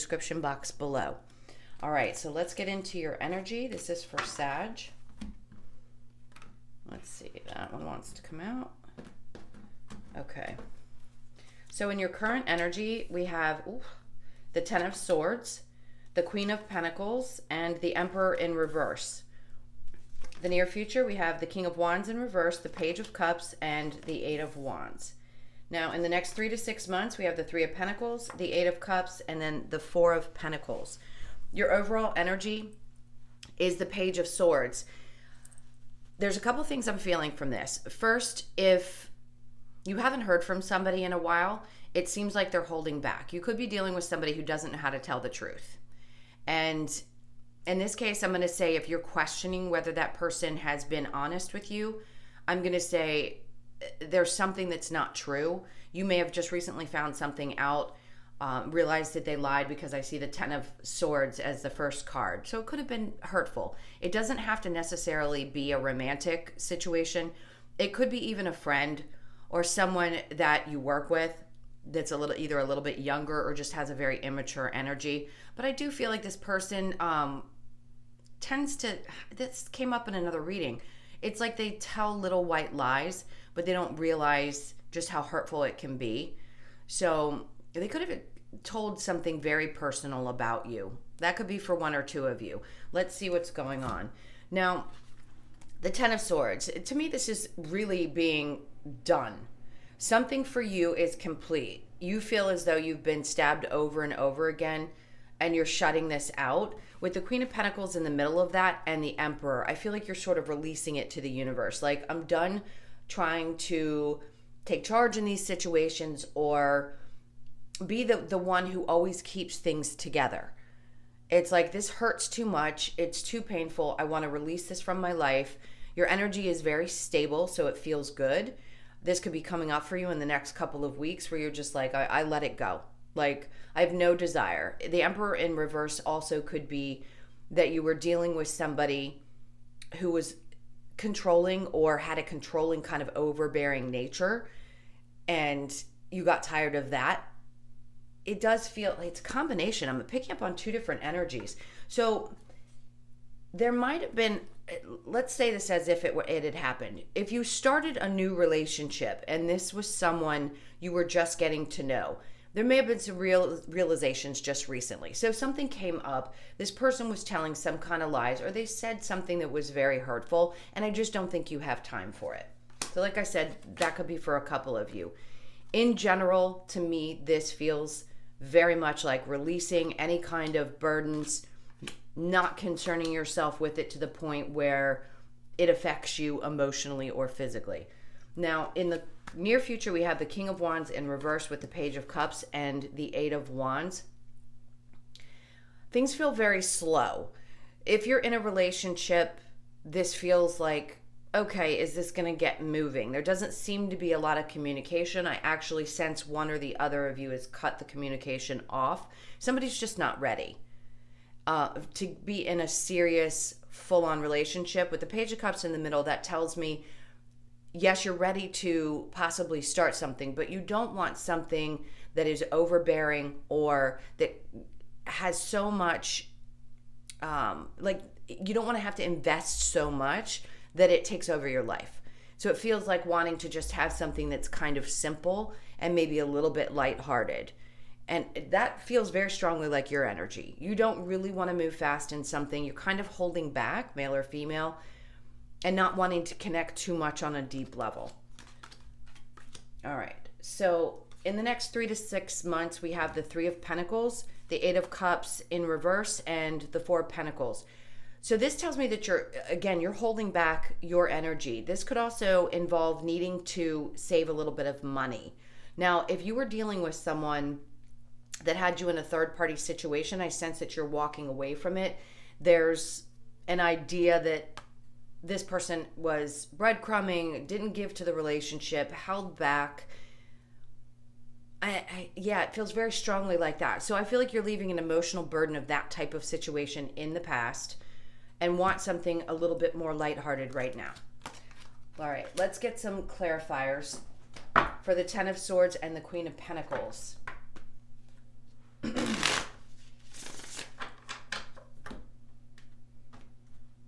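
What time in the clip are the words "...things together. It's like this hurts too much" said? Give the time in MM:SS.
01:59.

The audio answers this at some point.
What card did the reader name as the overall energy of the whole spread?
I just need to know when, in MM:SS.
00:33.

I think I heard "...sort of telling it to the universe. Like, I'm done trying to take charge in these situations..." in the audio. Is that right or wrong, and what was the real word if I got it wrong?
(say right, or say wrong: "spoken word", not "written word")
wrong: "releasing", not "telling".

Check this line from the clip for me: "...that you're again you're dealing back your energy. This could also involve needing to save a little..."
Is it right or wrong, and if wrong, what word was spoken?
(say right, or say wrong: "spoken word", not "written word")
wrong: "holding", not "dealing".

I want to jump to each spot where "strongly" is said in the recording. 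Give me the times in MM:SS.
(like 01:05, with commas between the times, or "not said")
03:59, 04:42.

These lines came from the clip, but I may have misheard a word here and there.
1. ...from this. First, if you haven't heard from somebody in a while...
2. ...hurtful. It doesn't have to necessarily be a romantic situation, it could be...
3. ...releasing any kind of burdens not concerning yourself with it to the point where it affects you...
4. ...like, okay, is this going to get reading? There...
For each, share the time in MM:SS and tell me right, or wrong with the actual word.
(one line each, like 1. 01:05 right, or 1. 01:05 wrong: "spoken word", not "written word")
1. 00:37 right
2. 01:03 right
3. 02:59 right
4. 03:20 wrong: "moving", not "reading".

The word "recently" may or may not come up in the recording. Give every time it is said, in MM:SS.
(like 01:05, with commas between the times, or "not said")
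00:56, 02:44.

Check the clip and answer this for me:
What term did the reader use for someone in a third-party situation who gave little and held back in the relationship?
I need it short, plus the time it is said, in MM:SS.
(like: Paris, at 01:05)
breadcrumbing, at 04:36.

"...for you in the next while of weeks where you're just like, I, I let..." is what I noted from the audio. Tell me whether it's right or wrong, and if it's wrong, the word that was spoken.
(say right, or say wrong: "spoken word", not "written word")
wrong: "couple", not "while".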